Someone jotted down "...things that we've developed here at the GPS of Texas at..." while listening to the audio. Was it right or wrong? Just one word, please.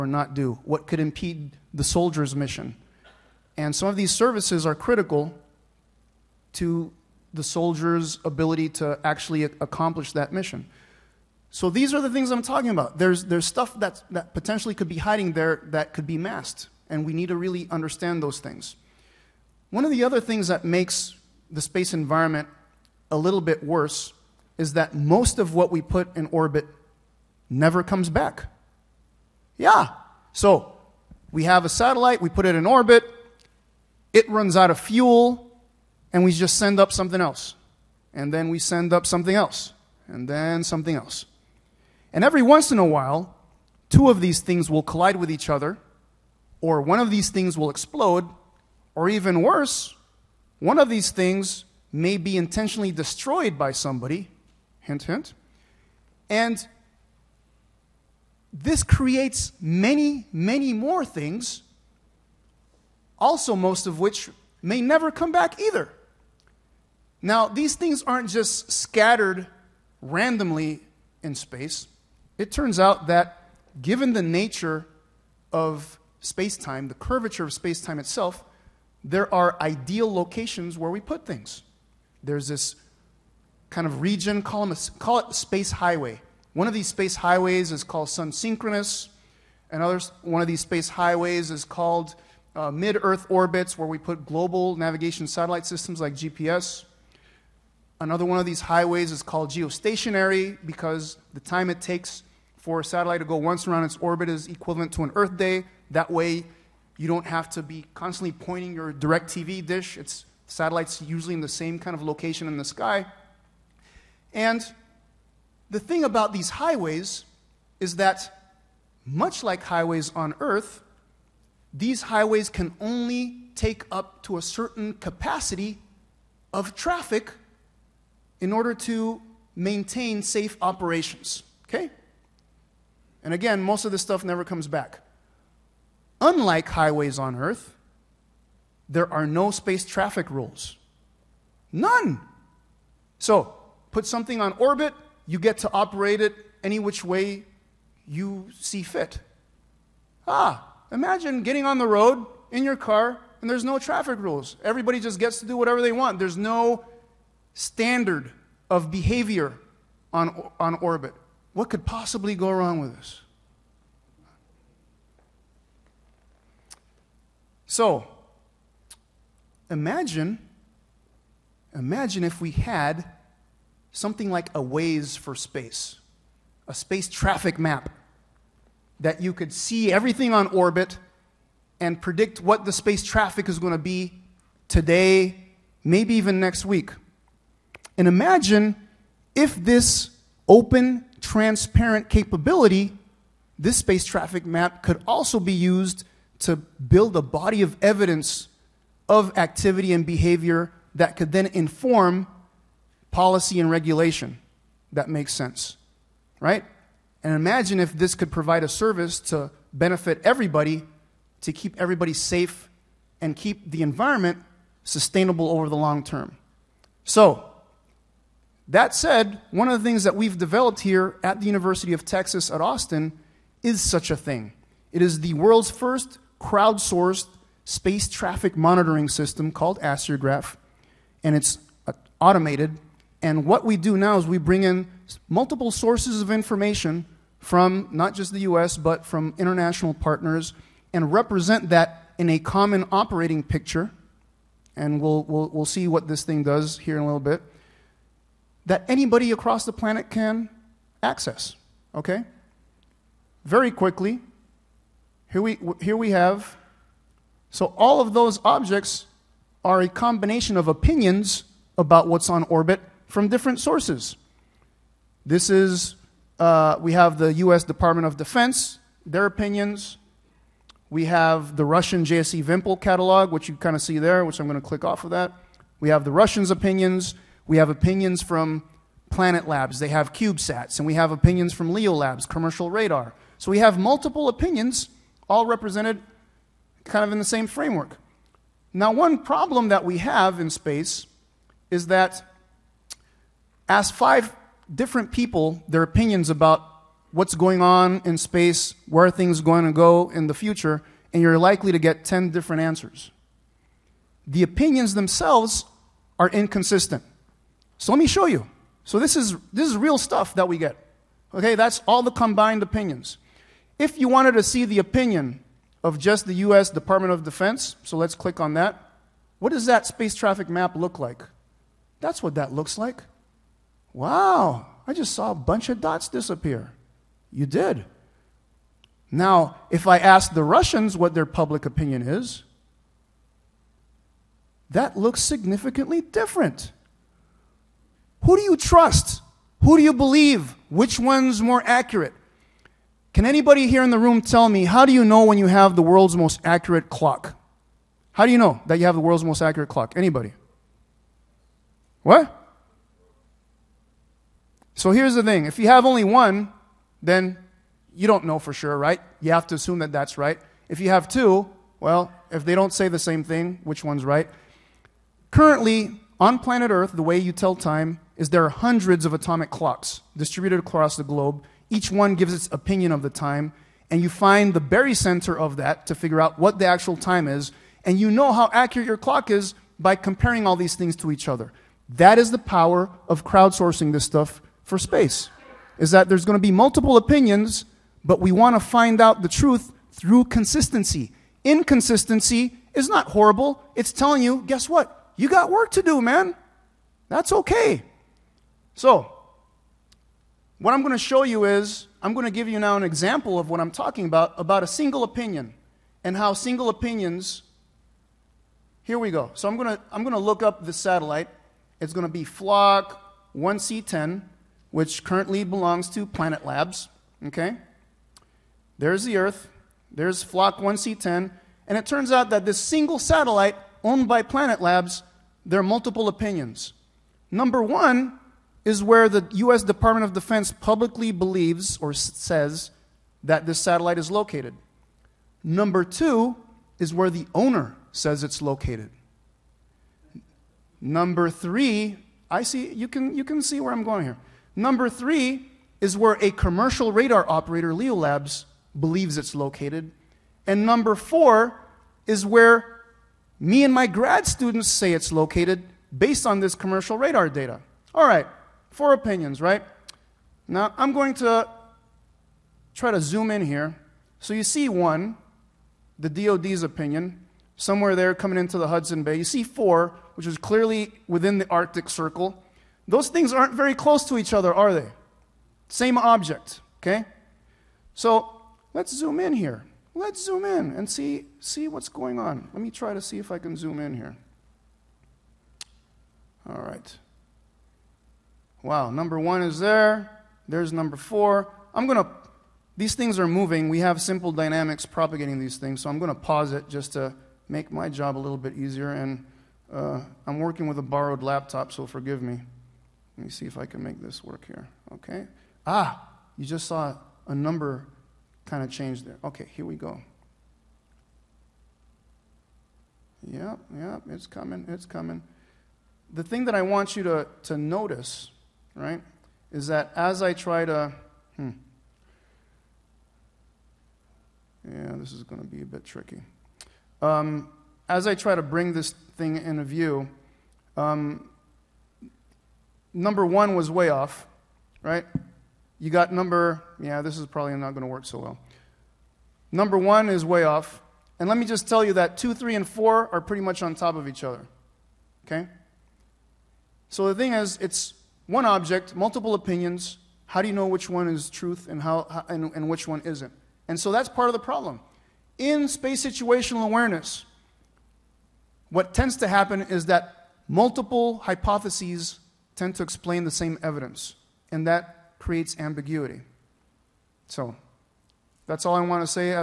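wrong.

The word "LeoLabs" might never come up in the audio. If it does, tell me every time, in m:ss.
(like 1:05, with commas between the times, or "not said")
4:41, 7:27.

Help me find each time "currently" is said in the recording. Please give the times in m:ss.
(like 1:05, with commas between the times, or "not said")
6:05, 6:55.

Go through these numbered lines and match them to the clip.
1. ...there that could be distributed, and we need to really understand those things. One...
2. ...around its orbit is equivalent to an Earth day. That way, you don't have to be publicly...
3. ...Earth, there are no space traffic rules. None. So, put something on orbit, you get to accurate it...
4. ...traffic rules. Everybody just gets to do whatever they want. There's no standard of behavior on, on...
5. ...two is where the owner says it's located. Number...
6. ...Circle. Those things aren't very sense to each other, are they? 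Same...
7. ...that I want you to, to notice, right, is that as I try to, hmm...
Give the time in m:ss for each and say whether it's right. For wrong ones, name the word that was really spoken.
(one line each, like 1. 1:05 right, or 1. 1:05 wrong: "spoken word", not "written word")
1. 0:15 wrong: "masked", not "distributed"
2. 1:43 wrong: "constantly", not "publicly"
3. 2:17 wrong: "operate", not "accurate"
4. 2:33 right
5. 7:15 right
6. 7:51 wrong: "close", not "sense"
7. 8:36 right.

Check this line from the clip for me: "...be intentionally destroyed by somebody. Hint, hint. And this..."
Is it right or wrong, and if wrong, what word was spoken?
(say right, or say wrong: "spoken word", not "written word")
right.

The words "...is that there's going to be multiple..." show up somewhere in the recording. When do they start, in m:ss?
6:25.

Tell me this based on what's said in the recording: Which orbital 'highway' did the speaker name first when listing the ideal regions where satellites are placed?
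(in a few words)
Sun Synchronous.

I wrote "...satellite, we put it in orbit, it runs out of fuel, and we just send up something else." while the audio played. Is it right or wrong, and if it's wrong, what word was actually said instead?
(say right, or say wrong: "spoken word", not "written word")
right.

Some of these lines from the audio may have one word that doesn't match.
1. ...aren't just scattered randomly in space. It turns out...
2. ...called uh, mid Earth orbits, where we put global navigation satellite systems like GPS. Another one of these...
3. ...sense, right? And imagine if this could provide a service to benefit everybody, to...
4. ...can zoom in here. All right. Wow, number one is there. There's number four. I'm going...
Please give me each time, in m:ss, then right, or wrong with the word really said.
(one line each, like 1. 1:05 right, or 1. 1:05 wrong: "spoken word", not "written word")
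1. 1:08 right
2. 1:31 right
3. 3:25 right
4. 8:03 right.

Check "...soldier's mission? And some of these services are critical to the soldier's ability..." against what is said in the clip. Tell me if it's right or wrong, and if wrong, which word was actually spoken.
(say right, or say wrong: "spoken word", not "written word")
right.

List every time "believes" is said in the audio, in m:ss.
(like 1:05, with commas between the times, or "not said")
5:39, 7:11, 7:28.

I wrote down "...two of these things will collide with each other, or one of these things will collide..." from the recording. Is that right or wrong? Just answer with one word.
wrong.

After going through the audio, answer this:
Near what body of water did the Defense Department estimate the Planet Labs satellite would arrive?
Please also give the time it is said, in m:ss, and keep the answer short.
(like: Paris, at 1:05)
Hudson Bay, at 7:48.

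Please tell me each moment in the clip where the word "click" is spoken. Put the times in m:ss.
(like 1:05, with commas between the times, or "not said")
4:34, 5:18.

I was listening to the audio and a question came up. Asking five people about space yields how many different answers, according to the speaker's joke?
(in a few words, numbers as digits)
10.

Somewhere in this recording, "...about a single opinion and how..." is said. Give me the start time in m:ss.
6:44.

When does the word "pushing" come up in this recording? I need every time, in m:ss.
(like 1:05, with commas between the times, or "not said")
not said.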